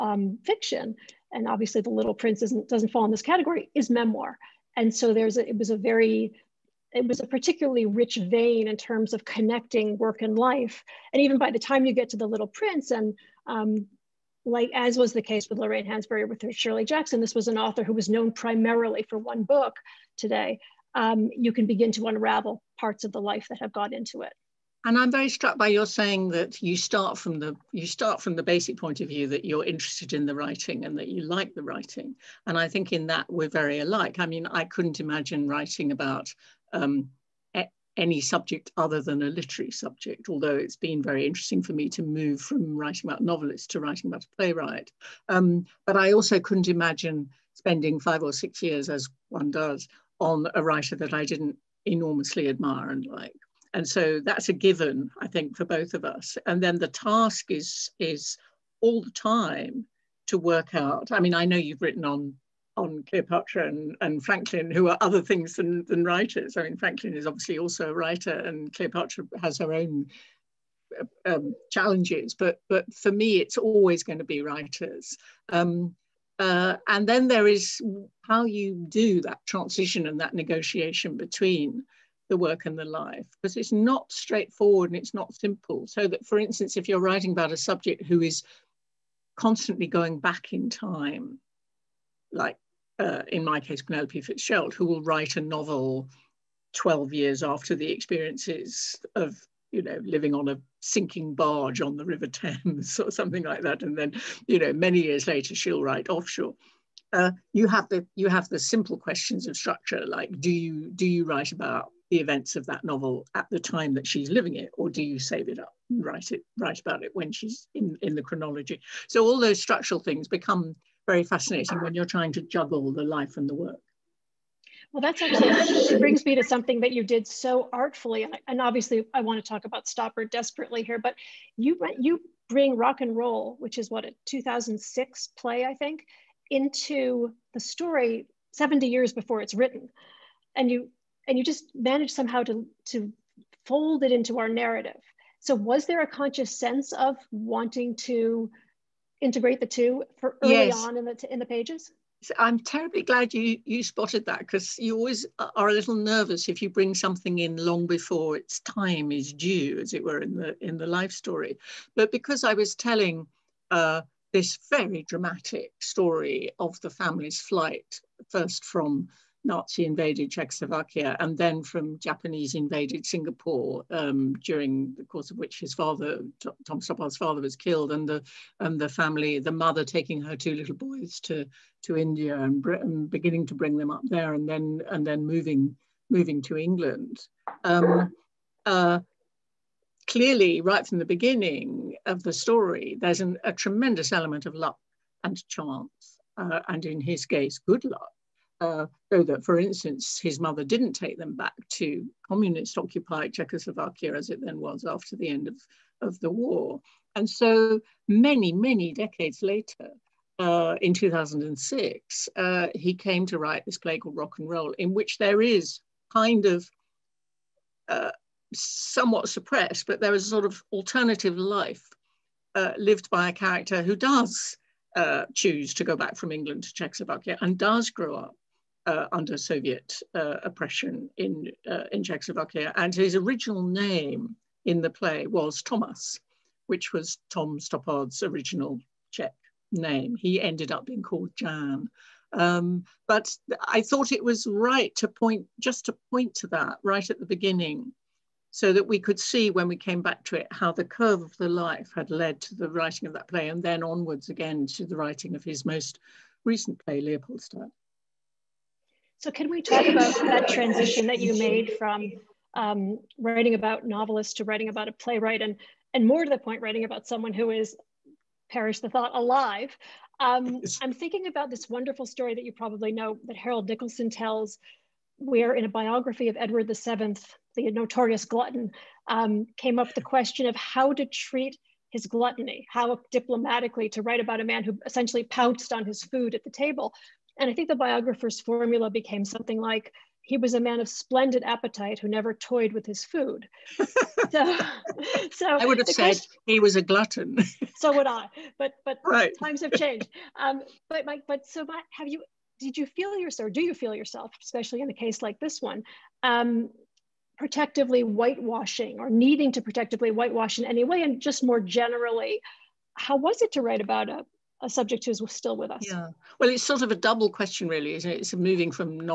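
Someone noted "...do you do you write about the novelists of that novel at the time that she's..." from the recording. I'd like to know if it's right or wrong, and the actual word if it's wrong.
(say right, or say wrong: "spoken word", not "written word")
wrong: "events", not "novelists".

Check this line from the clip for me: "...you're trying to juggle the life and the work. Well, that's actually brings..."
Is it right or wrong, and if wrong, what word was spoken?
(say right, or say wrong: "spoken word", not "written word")
right.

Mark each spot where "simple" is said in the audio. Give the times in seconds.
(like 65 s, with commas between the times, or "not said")
85 s, 108 s.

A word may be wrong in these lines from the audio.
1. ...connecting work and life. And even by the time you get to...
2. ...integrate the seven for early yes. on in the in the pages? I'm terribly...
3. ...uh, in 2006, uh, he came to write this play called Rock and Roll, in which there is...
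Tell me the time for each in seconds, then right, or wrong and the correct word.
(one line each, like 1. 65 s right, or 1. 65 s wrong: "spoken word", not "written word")
1. 9 s right
2. 149 s wrong: "two", not "seven"
3. 210 s right.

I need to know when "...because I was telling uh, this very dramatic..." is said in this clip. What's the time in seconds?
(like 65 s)
162 s.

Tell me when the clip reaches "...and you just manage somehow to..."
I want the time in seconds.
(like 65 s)
141 s.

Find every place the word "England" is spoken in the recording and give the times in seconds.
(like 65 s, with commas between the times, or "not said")
186 s, 226 s.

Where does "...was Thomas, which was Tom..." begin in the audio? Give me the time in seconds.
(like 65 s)
235 s.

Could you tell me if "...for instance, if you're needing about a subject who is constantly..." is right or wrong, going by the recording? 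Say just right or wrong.
wrong.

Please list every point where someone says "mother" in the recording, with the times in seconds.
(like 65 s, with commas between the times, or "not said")
179 s, 200 s.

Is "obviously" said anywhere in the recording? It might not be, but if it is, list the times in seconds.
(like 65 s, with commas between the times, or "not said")
1 s, 67 s, 128 s.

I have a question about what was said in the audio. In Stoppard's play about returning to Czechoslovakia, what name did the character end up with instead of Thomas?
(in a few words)
Jan.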